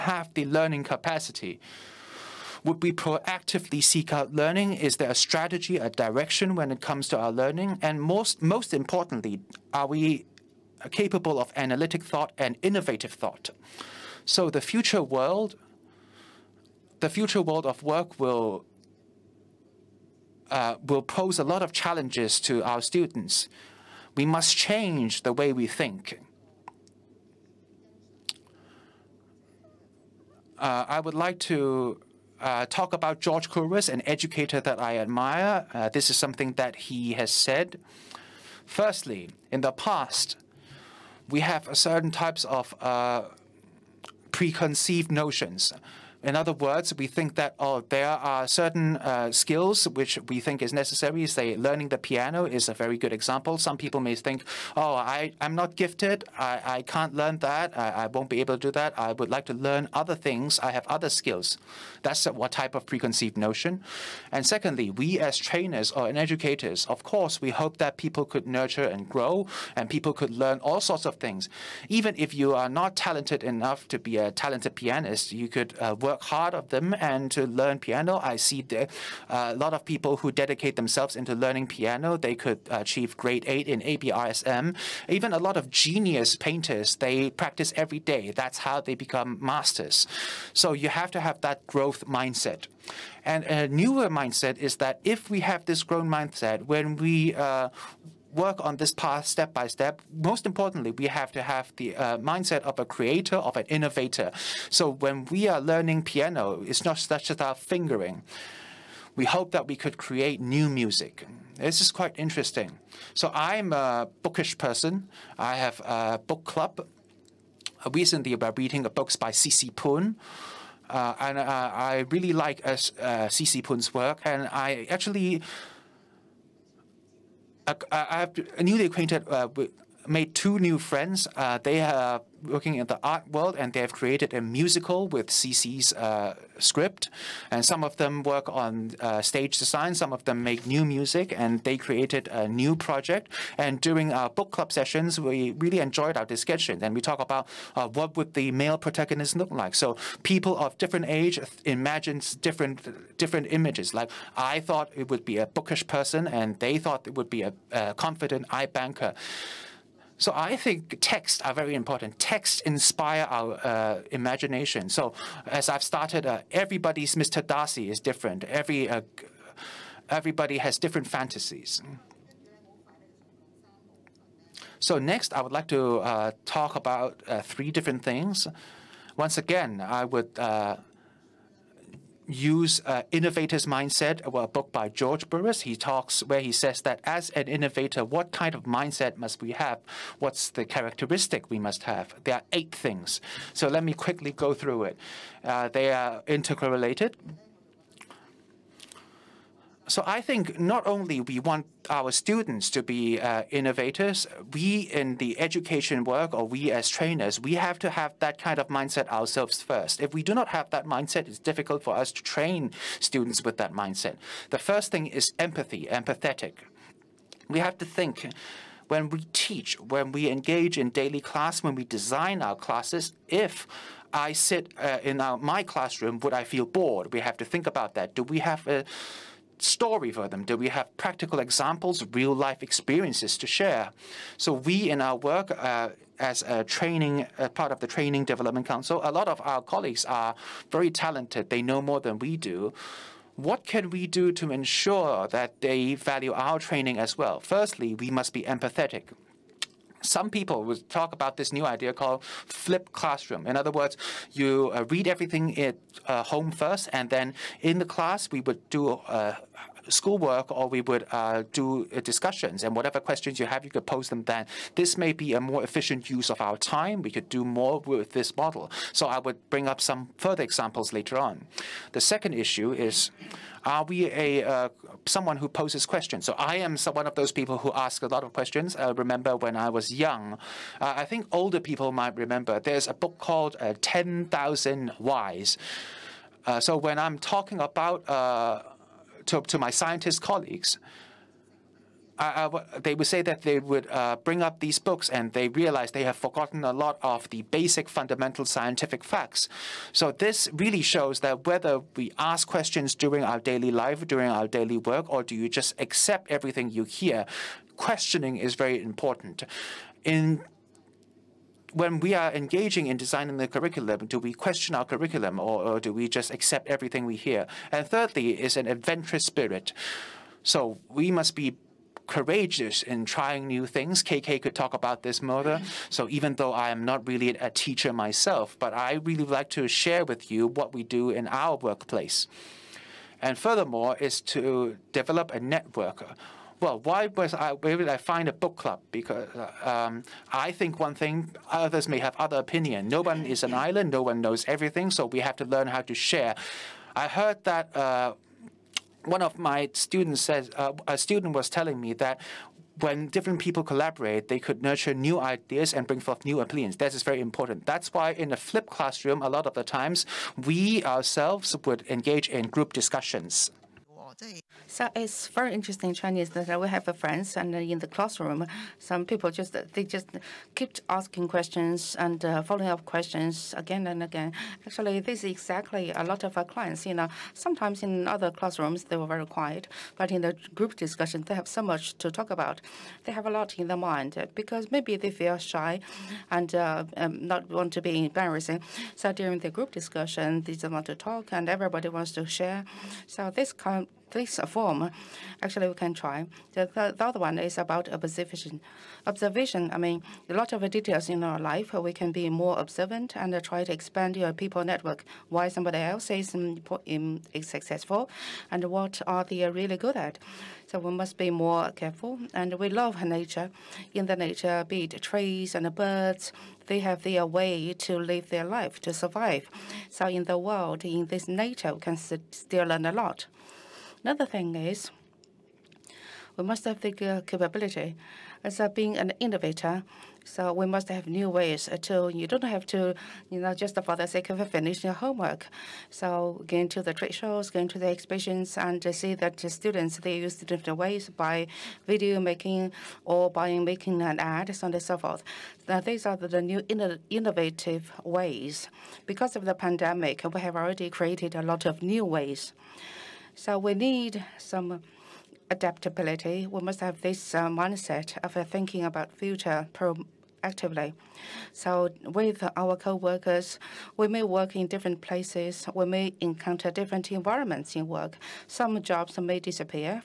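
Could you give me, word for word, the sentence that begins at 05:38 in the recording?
Because uh, um, I think one thing, others may have other opinion.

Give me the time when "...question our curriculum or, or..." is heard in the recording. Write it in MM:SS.
05:14.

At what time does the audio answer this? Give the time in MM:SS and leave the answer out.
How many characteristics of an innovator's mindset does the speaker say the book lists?
03:12.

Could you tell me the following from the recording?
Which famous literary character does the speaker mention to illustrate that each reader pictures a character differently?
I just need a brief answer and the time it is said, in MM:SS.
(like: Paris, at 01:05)
Mr. Darcy, at 02:47.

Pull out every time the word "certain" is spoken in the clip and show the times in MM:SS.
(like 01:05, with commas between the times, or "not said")
00:41, 00:48.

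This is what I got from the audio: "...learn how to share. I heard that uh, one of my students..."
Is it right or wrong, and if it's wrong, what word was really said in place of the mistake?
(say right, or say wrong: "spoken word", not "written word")
right.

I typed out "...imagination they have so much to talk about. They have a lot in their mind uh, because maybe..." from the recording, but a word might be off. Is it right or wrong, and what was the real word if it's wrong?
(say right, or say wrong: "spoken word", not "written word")
wrong: "discussion", not "imagination".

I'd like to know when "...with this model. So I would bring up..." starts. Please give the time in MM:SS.
04:27.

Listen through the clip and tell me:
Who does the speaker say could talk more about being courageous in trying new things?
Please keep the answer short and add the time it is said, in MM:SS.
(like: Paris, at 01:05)
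KK, at 05:24.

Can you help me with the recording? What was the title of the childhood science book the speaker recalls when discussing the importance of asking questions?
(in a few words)
10,000 Whys.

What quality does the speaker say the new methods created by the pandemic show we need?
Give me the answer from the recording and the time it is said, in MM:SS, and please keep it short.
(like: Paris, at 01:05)
adaptability, at 07:35.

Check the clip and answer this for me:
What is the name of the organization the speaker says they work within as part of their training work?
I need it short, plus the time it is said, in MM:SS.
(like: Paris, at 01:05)
Training Development Council, at 03:57.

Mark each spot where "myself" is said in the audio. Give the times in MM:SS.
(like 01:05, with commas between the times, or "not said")
05:27.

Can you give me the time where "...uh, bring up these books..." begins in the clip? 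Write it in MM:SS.
04:53.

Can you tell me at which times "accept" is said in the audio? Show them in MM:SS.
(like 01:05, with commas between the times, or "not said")
05:05, 05:16.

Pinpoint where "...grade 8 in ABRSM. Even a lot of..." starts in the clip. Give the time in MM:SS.
01:23.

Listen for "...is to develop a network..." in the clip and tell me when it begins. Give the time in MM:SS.
05:33.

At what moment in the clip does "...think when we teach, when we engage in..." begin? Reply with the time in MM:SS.
03:37.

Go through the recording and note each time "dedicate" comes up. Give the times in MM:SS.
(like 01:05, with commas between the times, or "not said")
01:20.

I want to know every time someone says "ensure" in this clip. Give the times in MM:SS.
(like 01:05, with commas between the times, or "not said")
04:04.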